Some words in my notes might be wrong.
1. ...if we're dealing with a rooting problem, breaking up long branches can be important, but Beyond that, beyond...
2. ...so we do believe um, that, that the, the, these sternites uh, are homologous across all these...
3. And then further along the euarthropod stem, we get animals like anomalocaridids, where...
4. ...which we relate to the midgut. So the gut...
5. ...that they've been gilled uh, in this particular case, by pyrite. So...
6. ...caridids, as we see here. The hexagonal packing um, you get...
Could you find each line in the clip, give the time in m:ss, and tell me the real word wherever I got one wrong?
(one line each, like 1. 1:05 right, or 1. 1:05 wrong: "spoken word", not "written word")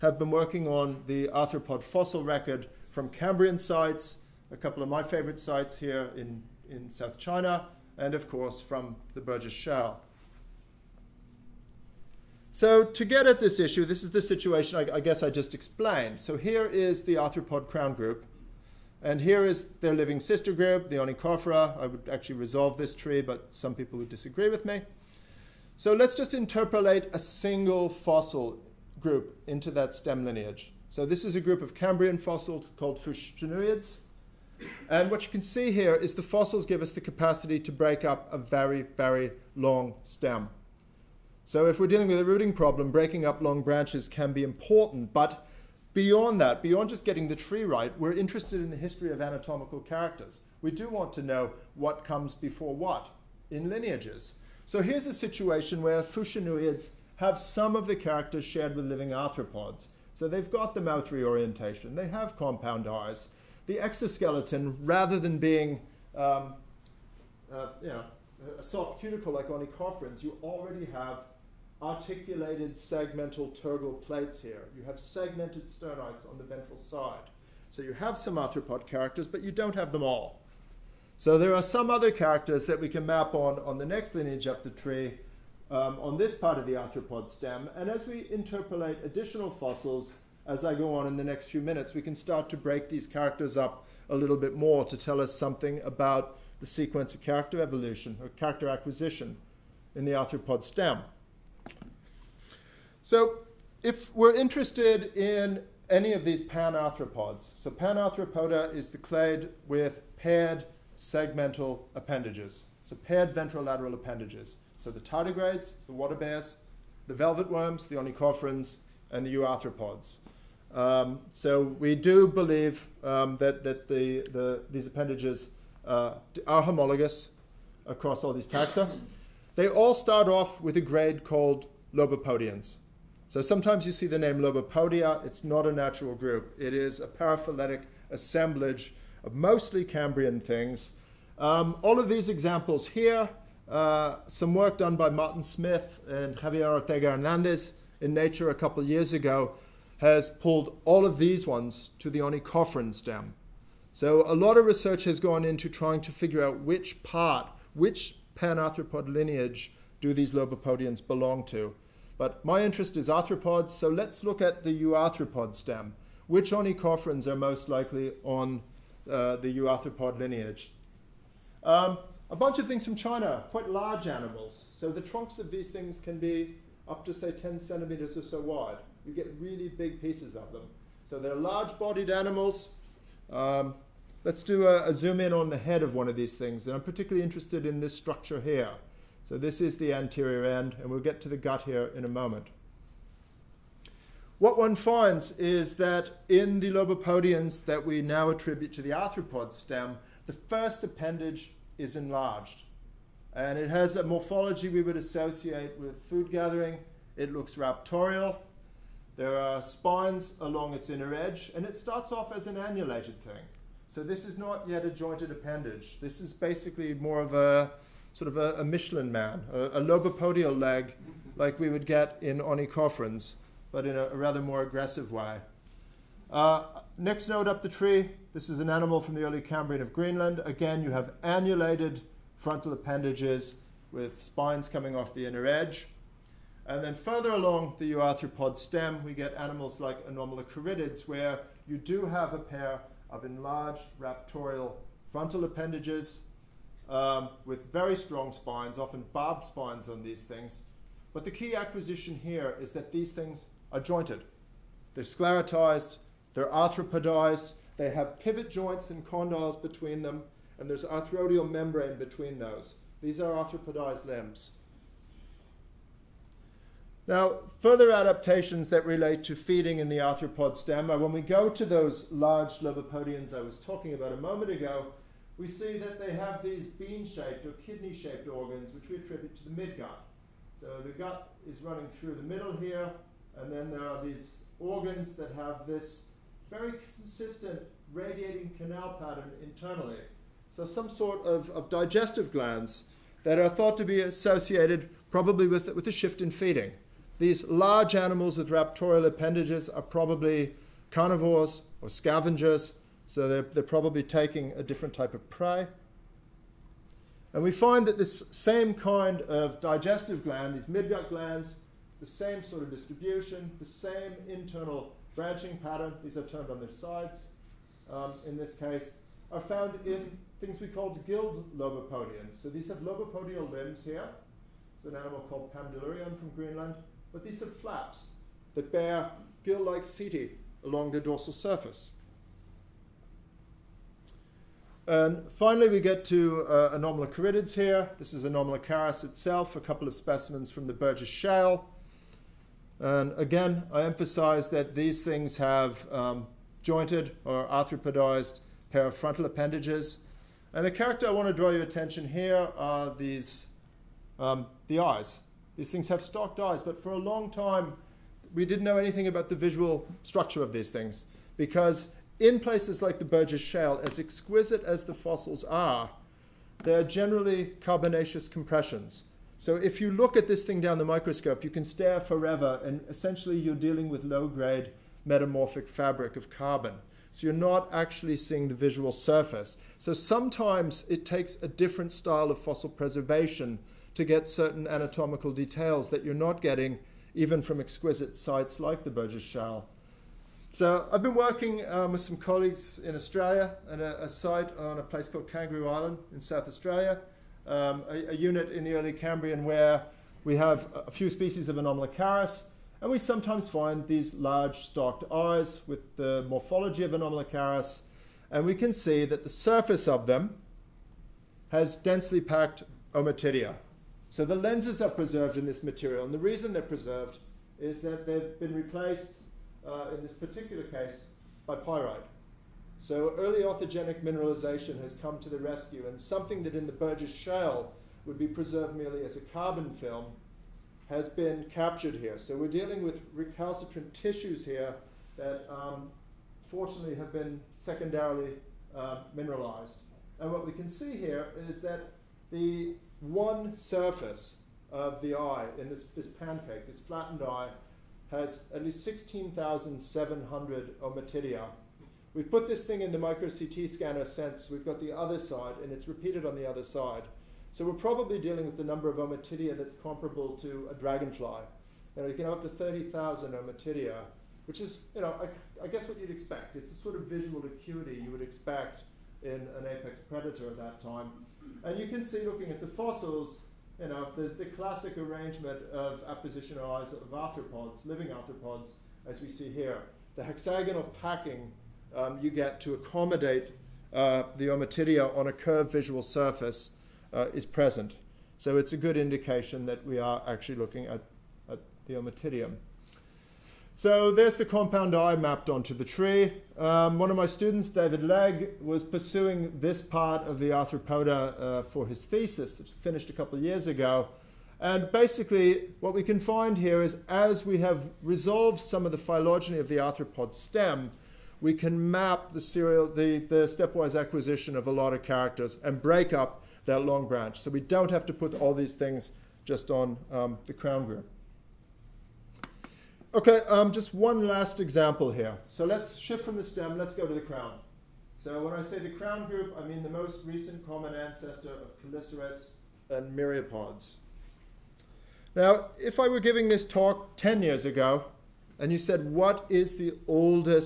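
1. 0:41 right
2. 2:01 wrong: "appendages", not "sternites"
3. 3:56 right
4. 4:38 wrong: "attribute", not "relate"
5. 6:57 wrong: "replaced", not "gilled"
6. 7:58 wrong: "arthropods", not "caridids".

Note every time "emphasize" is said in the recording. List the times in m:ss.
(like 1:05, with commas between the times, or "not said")
5:43.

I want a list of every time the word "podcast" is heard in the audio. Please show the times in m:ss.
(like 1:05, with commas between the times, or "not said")
not said.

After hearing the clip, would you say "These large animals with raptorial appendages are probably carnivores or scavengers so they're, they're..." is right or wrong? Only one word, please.
right.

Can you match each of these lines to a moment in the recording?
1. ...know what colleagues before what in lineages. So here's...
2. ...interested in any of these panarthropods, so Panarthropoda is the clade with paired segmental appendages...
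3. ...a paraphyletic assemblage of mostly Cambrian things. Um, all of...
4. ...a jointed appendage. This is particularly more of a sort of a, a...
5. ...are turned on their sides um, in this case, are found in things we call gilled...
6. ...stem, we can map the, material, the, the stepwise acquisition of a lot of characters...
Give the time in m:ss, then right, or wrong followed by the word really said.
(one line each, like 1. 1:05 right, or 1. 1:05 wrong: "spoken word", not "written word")
1. 0:51 wrong: "comes", not "colleagues"
2. 1:44 right
3. 2:16 right
4. 3:34 wrong: "basically", not "particularly"
5. 5:16 right
6. 8:30 wrong: "serial", not "material".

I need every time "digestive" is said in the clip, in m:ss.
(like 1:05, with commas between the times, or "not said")
4:51, 5:09.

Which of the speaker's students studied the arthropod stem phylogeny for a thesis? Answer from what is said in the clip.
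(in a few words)
David Legg.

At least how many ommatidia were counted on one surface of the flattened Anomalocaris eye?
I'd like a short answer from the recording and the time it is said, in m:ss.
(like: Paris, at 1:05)
16,700, at 7:28.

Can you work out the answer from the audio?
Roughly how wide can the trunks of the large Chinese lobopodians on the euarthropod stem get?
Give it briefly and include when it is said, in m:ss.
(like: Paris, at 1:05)
10 centimeters, at 2:57.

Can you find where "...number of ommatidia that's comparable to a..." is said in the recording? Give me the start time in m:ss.
7:38.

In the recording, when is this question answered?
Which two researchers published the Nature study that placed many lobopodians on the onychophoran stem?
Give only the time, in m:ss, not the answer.
2:25.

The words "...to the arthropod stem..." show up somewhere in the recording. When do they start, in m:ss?
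3:18.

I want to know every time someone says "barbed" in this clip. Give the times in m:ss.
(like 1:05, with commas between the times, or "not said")
4:09.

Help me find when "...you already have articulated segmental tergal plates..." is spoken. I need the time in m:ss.
1:10.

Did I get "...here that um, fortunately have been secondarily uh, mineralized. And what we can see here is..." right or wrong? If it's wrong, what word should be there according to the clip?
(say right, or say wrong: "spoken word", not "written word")
right.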